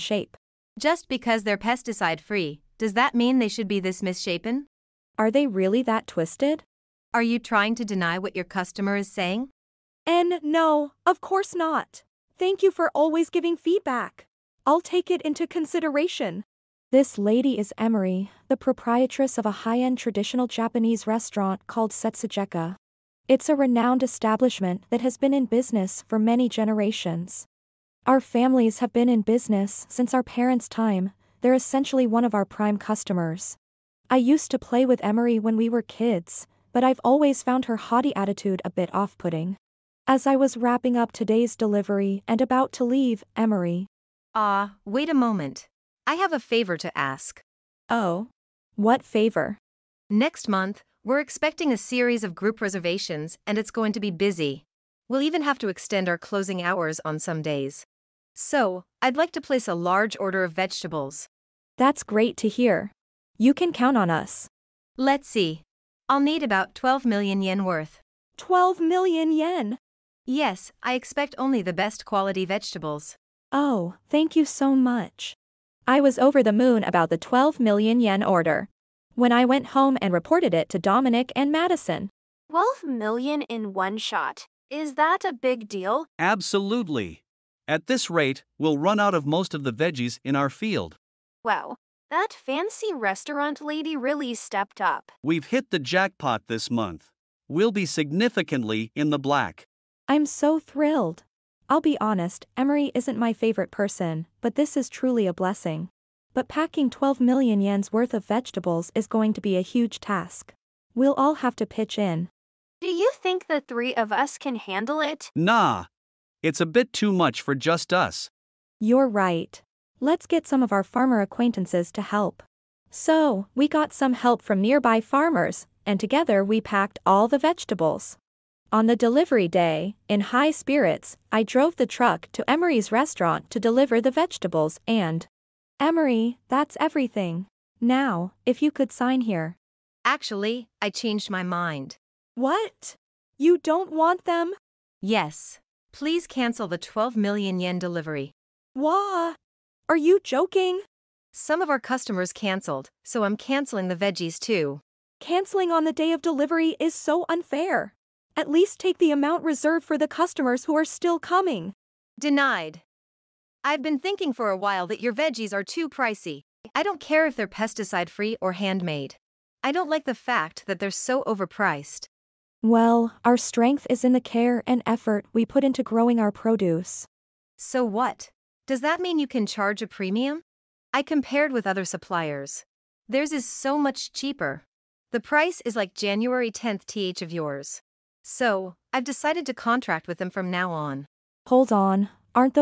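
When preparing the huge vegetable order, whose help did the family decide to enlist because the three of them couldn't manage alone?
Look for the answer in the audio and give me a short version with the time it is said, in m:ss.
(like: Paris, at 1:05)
farmer acquaintances, at 2:00.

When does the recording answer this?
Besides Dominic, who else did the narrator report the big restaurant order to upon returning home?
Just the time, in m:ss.
1:21.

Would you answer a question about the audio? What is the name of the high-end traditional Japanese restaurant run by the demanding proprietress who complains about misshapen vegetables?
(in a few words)
Setsugeka.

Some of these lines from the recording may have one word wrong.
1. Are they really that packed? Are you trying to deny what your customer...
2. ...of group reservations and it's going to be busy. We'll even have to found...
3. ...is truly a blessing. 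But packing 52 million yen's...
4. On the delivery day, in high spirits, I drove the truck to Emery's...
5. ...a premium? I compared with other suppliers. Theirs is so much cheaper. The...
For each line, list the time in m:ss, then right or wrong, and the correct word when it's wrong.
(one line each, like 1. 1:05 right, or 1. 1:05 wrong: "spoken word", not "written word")
1. 0:05 wrong: "twisted", not "packed"
2. 0:52 wrong: "extend", not "found"
3. 1:44 wrong: "12", not "52"
4. 2:08 right
5. 2:59 right.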